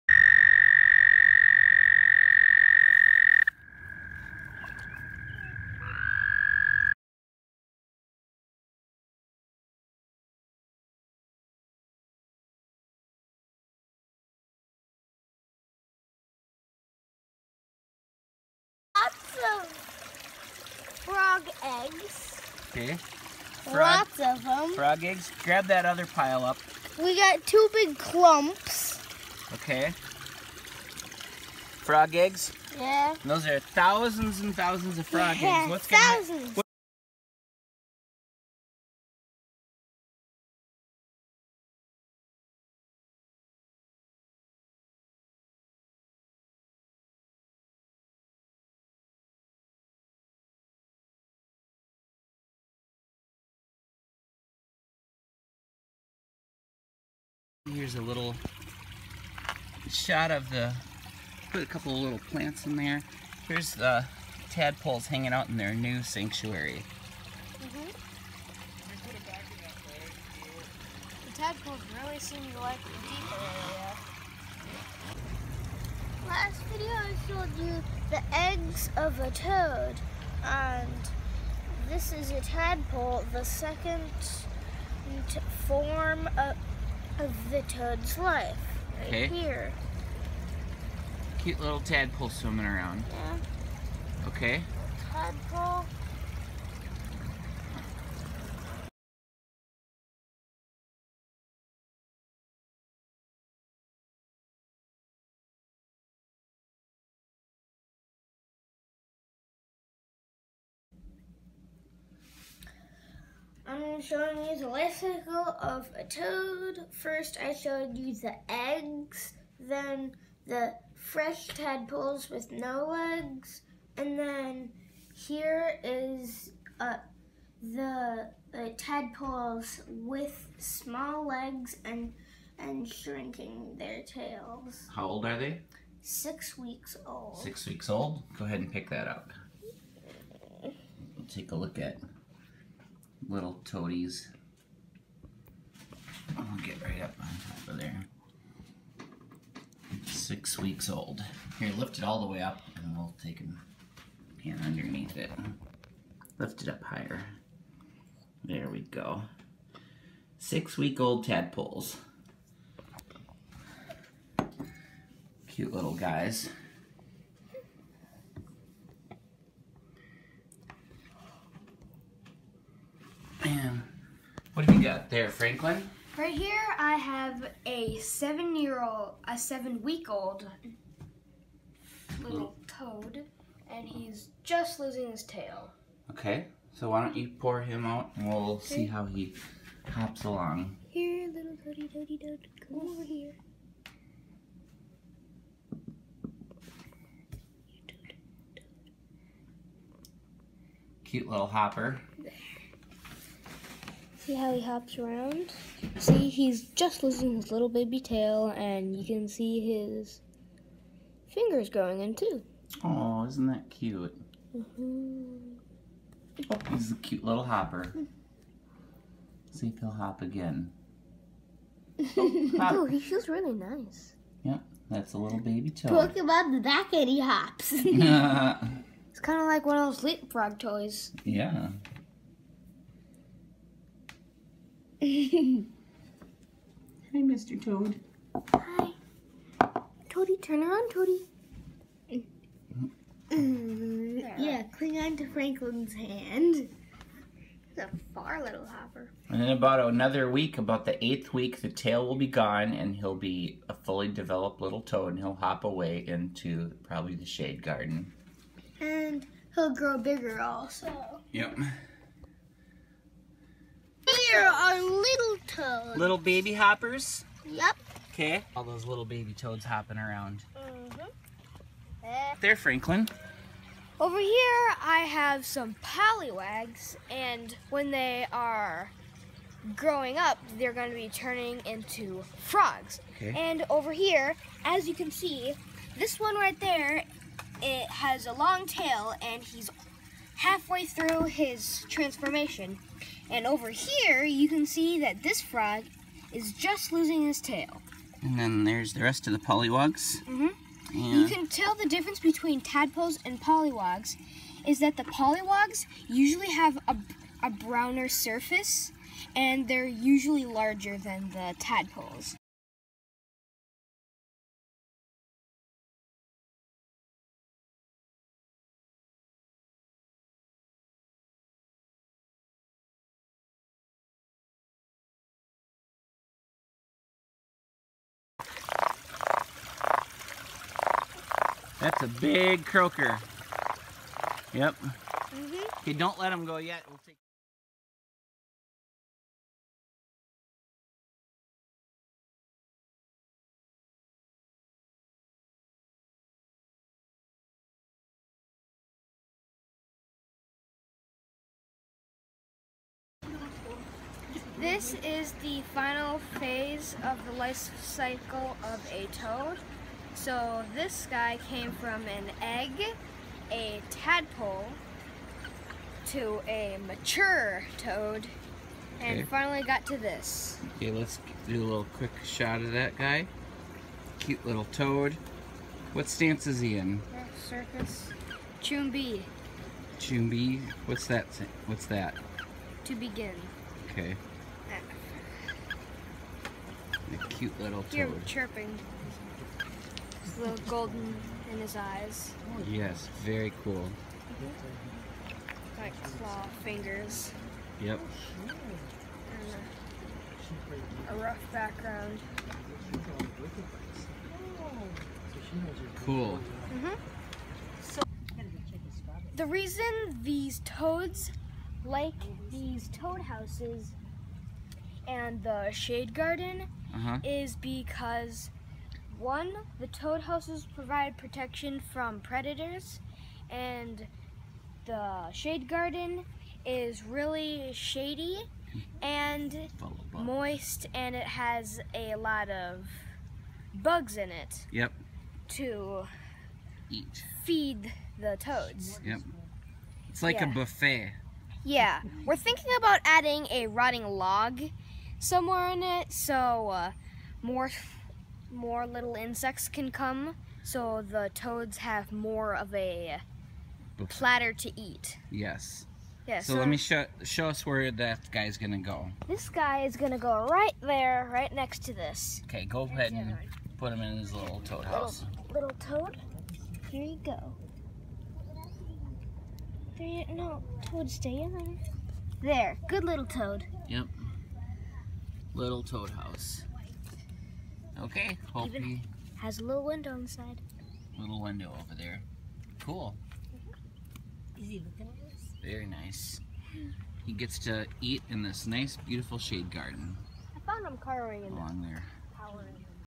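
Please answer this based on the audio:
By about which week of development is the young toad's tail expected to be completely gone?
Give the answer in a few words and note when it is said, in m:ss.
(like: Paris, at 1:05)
The 8th week, at 4:10.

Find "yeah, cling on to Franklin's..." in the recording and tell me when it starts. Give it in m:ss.
4:04.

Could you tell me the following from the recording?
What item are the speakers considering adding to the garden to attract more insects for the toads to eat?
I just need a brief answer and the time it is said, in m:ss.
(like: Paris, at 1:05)
A rotting log, at 7:23.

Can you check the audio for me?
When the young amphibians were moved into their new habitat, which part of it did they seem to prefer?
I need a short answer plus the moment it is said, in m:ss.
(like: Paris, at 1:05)
The deeper area, at 1:12.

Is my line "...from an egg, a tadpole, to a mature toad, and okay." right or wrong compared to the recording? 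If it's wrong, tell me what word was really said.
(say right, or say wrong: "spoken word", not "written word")
right.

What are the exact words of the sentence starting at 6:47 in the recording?
So the reason these toads like these toad houses and the shade garden uh -huh.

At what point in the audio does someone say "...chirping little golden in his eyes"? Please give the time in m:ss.
6:28.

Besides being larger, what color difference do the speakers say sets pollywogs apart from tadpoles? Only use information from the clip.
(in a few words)
Browner.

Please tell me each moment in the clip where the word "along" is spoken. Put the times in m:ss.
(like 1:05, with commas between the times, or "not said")
3:10, 8:11.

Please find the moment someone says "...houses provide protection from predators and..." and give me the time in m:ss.
7:00.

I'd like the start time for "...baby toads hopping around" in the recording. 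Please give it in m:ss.
4:29.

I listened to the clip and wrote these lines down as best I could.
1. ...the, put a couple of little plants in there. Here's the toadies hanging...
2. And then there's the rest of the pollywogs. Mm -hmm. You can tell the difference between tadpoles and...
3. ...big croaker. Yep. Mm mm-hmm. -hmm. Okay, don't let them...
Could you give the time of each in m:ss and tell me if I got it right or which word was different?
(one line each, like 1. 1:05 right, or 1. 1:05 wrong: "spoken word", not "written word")
1. 1:00 wrong: "tadpoles", not "toadies"
2. 4:58 right
3. 5:32 right.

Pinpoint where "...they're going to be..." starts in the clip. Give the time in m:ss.
4:40.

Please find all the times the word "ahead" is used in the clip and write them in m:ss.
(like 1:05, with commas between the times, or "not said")
2:18, 7:42.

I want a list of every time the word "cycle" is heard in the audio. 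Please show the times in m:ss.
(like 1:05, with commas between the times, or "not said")
1:54, 5:57.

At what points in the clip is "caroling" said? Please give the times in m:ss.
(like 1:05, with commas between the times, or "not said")
8:10.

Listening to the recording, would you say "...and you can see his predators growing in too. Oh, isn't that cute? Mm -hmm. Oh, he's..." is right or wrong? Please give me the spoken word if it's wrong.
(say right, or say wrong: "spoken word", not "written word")
wrong: "fingers", not "predators".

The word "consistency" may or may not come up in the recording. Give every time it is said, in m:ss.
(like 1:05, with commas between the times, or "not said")
not said.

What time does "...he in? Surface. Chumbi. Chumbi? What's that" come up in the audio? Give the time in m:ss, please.
6:16.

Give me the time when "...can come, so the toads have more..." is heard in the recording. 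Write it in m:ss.
7:29.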